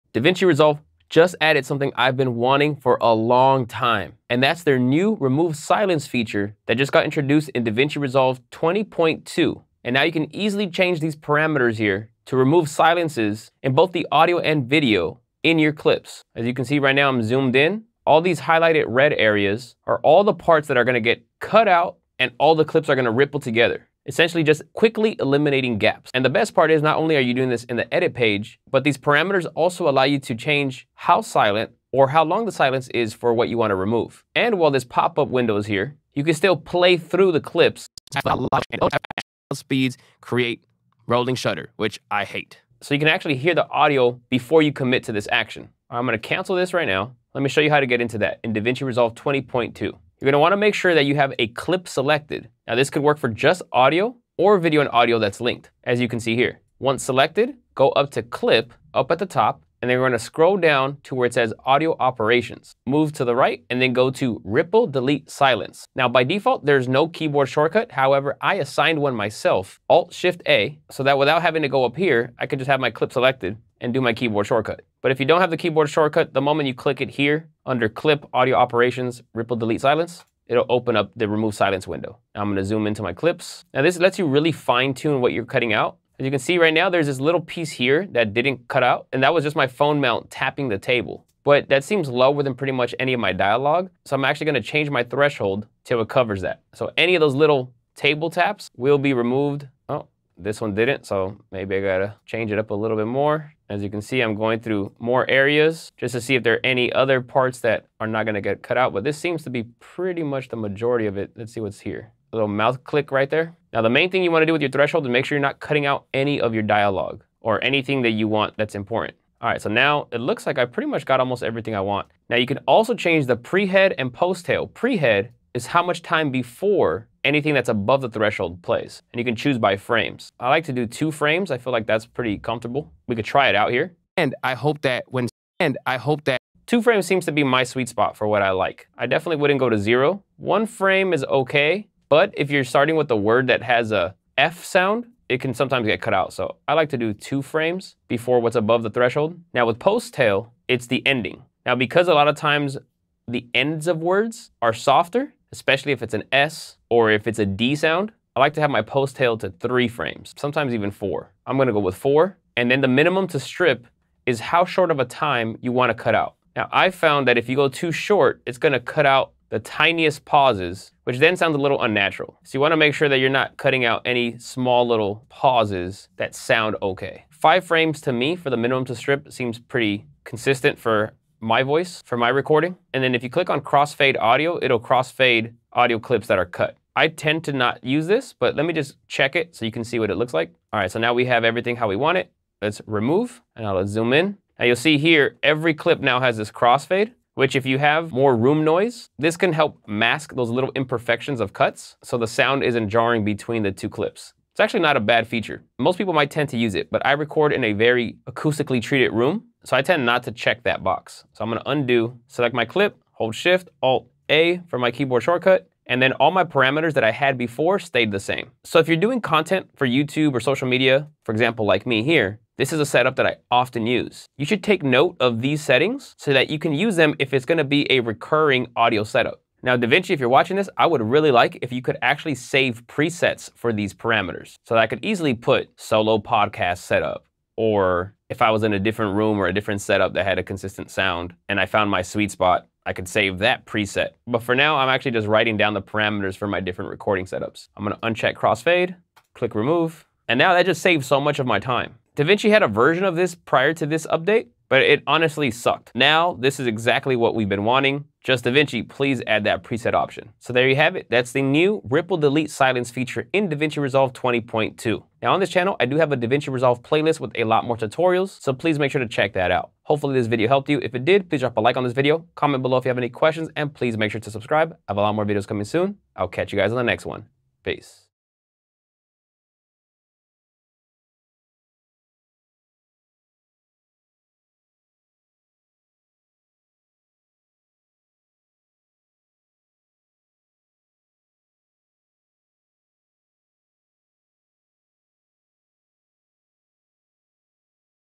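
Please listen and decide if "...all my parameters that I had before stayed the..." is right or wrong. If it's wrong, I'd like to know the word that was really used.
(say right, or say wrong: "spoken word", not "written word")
right.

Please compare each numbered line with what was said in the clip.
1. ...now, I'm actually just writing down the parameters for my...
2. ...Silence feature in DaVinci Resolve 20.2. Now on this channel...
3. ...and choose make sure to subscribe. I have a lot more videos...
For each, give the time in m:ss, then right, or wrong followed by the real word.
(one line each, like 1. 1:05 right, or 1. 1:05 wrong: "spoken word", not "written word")
1. 4:04 right
2. 4:22 right
3. 4:33 wrong: "please", not "choose".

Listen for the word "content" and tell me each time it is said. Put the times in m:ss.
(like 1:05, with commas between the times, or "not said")
3:39.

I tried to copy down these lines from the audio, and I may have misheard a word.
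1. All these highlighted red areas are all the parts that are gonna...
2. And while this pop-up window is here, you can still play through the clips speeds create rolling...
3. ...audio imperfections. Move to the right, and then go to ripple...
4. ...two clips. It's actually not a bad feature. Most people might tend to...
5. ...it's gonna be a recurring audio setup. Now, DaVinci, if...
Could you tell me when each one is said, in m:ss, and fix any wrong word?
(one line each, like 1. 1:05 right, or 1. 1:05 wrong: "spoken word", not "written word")
1. 0:18 right
2. 0:34 right
3. 1:01 wrong: "operations", not "imperfections"
4. 3:23 right
5. 3:47 right.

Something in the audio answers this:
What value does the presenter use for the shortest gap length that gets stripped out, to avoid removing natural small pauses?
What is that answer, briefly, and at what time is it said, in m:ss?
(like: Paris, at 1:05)
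5 frames, at 2:57.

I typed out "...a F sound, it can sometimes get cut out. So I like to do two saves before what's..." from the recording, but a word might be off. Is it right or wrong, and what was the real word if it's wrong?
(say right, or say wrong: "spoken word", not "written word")
wrong: "frames", not "saves".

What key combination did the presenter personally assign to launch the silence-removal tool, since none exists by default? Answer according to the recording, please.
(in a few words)
Alt Shift A.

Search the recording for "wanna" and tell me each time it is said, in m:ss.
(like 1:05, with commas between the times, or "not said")
0:50, 1:54, 2:45, 2:52.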